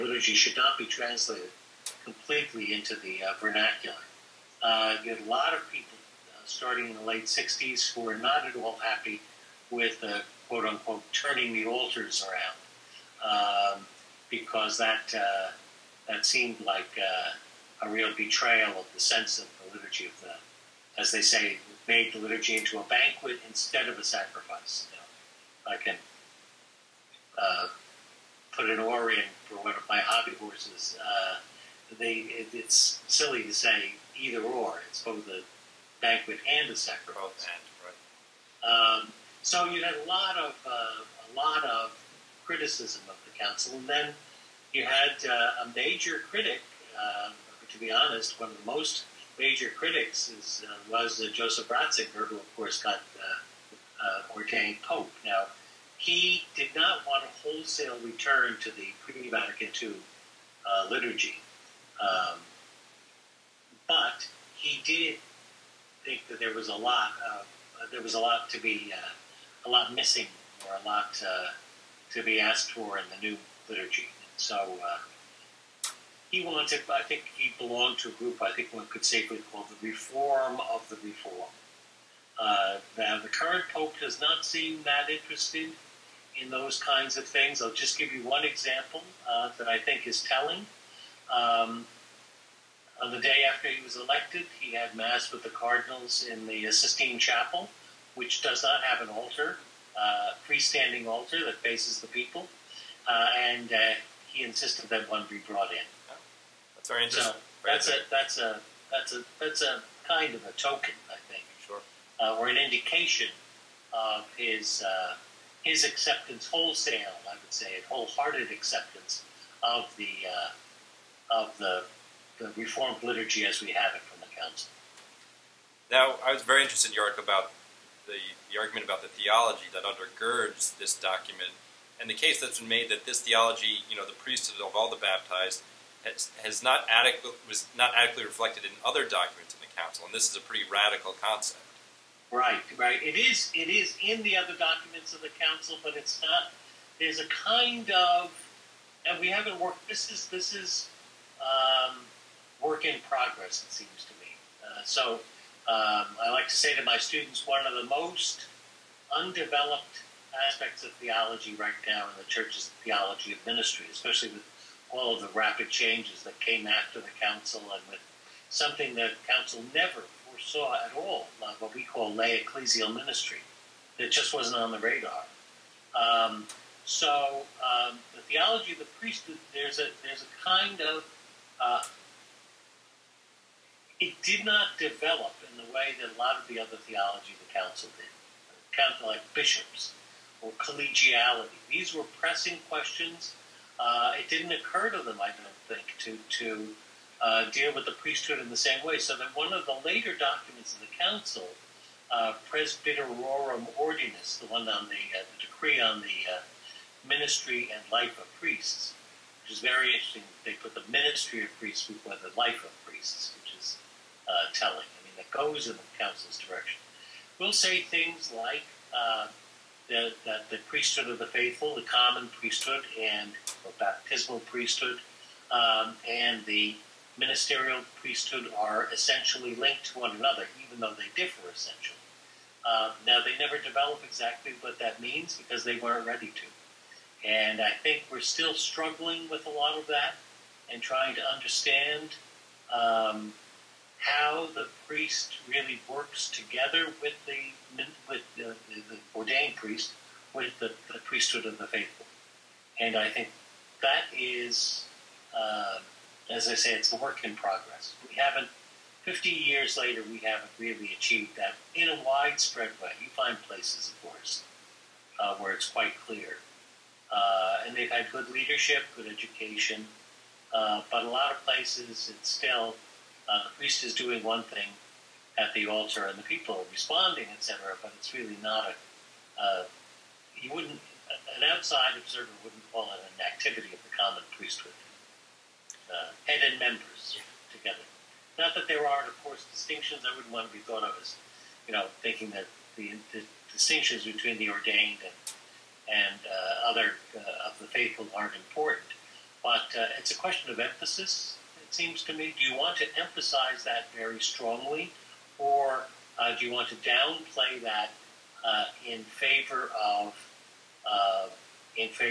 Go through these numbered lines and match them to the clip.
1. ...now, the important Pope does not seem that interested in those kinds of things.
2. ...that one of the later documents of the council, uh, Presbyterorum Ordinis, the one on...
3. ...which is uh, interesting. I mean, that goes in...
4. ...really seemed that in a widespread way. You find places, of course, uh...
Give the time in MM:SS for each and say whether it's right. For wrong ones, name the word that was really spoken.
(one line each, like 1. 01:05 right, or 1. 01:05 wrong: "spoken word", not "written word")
1. 01:22 wrong: "current", not "important"
2. 03:19 right
3. 03:33 wrong: "telling", not "interesting"
4. 04:20 wrong: "achieved", not "seemed".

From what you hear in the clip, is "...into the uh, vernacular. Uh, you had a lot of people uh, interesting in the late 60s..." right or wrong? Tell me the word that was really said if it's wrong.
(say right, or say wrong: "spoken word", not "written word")
wrong: "starting", not "interesting".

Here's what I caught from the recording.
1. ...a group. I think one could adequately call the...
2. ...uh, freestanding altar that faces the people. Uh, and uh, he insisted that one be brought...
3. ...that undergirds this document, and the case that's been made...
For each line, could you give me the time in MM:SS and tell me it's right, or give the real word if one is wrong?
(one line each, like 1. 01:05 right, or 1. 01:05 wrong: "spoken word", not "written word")
1. 01:18 wrong: "safely", not "adequately"
2. 01:39 right
3. 02:09 right.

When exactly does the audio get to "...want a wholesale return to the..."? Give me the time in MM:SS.
00:57.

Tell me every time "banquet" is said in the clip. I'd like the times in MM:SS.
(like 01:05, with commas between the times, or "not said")
00:22, 00:35.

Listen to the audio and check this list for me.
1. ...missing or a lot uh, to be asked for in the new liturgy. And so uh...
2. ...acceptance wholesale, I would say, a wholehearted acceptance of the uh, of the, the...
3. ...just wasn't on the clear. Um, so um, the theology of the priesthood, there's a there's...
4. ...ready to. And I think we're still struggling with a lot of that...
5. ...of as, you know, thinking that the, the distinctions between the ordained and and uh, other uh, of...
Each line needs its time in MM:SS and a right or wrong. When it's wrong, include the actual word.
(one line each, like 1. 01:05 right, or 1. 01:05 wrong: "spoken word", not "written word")
1. 01:09 right
2. 01:55 right
3. 02:54 wrong: "radar", not "clear"
4. 03:56 right
5. 04:50 right.